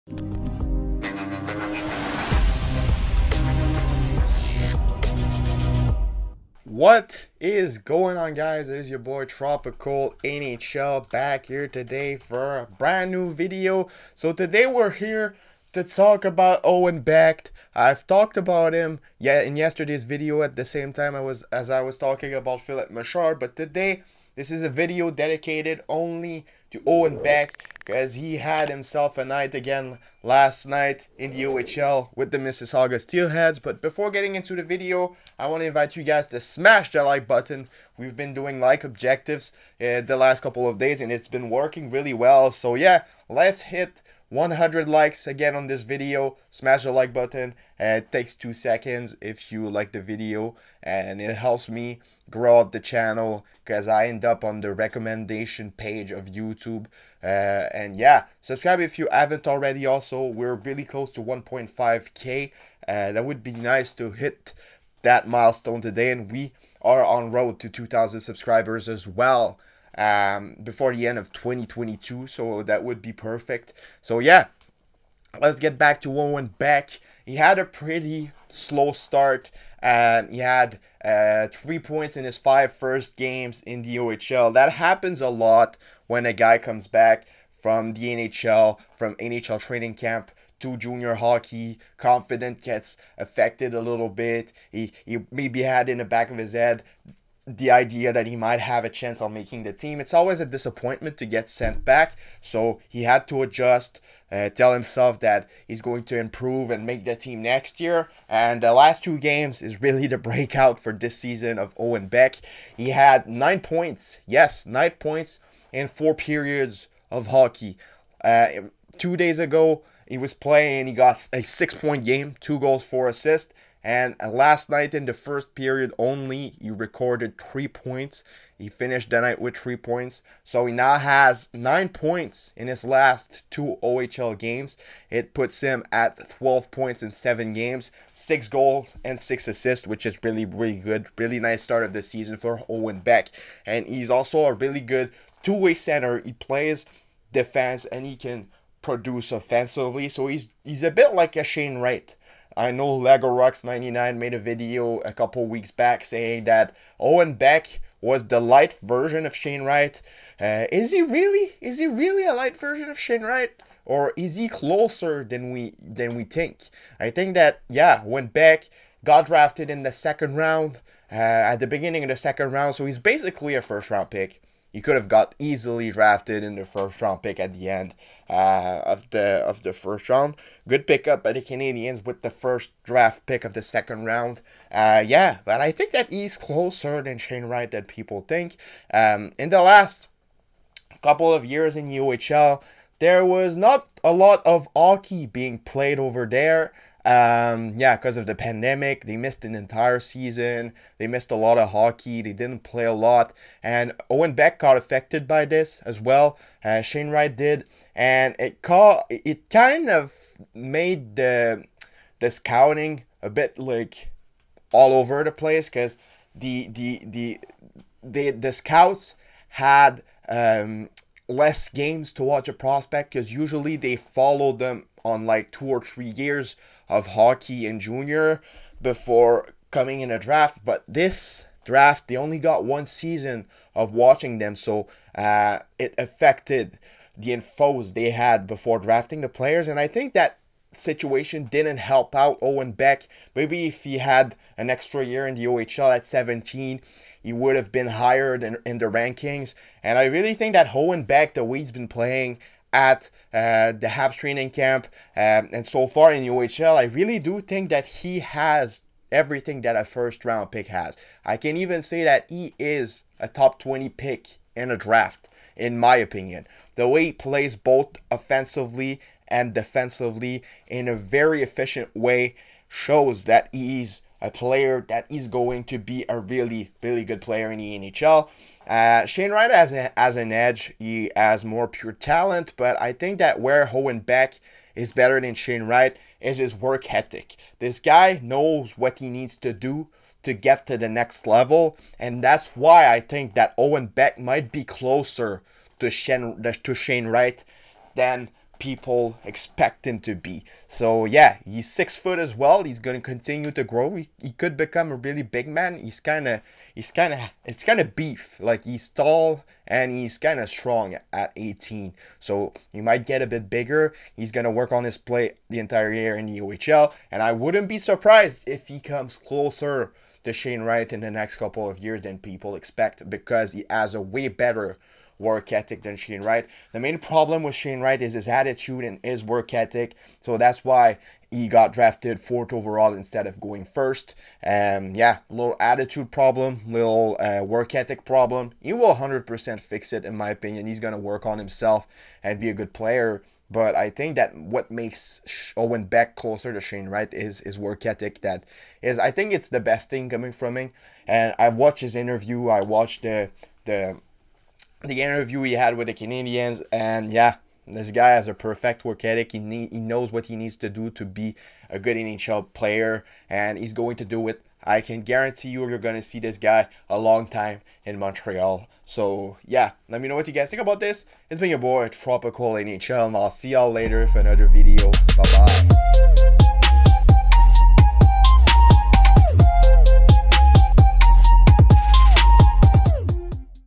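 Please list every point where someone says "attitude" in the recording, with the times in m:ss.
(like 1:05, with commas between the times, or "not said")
5:28, 5:35.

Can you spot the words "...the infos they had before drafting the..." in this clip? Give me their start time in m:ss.
3:57.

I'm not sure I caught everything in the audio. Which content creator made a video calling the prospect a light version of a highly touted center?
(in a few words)
Legorox99.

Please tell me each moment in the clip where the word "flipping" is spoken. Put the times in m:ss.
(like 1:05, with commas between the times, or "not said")
not said.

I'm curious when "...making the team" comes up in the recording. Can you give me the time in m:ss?
1:39.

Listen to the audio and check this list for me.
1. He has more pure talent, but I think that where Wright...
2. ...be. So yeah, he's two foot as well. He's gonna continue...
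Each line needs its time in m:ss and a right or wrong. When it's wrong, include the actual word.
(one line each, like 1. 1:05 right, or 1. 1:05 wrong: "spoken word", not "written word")
1. 4:40 wrong: "Beck", not "Wright"
2. 5:00 wrong: "six", not "two".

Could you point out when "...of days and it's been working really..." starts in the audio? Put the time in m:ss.
0:40.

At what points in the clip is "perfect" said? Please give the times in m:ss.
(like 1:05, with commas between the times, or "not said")
1:13, 5:58.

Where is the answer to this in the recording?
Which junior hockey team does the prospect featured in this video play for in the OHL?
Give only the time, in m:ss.
0:32.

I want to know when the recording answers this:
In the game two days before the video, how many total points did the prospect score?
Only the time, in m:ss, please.
2:01.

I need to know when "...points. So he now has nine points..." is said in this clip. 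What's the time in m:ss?
2:09.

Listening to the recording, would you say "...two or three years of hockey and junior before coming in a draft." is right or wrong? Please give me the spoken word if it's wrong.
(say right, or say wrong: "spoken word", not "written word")
right.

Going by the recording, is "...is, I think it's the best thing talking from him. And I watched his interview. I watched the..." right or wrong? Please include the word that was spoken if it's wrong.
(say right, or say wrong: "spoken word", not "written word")
wrong: "coming", not "talking".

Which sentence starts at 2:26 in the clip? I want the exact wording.
He plays defense and he can produce offensively.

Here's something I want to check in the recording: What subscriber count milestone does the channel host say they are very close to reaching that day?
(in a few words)
1.5k.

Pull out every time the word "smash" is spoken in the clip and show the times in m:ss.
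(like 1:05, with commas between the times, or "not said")
0:36, 0:46.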